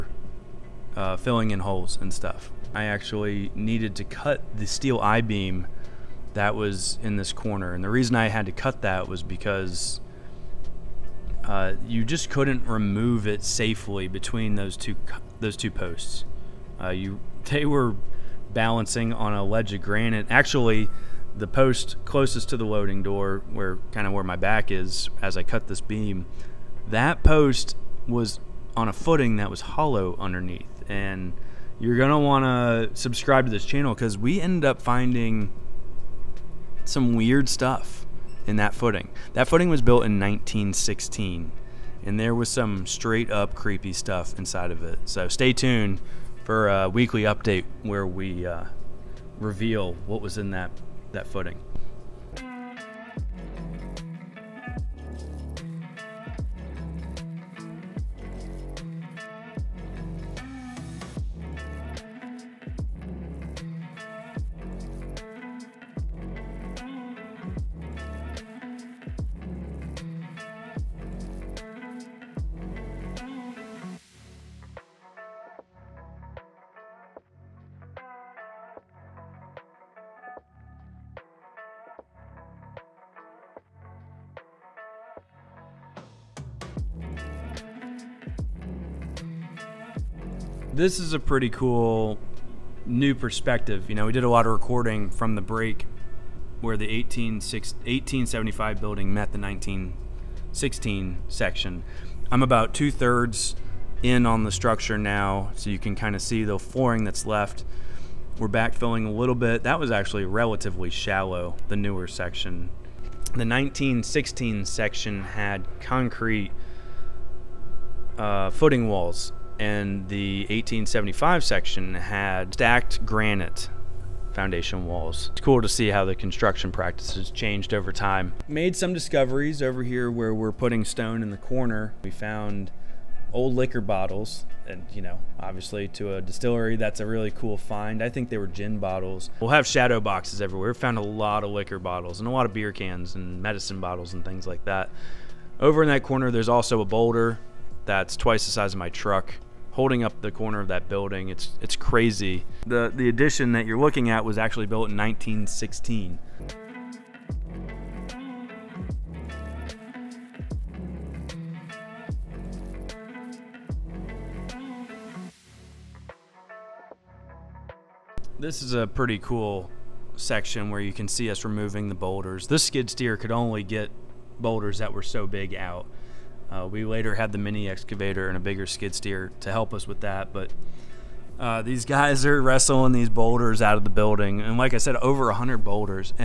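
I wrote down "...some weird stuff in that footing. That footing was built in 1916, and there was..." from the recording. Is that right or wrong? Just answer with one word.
right.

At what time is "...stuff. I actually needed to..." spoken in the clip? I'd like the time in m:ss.
0:02.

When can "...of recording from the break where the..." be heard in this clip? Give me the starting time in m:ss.
1:34.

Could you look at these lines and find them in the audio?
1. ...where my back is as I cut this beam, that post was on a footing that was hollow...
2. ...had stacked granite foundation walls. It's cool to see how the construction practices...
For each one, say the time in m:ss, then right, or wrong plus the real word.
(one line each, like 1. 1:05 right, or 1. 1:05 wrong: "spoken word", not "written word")
1. 0:24 right
2. 2:01 right.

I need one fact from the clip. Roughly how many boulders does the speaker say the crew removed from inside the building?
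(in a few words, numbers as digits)
over 100.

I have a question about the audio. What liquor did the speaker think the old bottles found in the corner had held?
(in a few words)
gin.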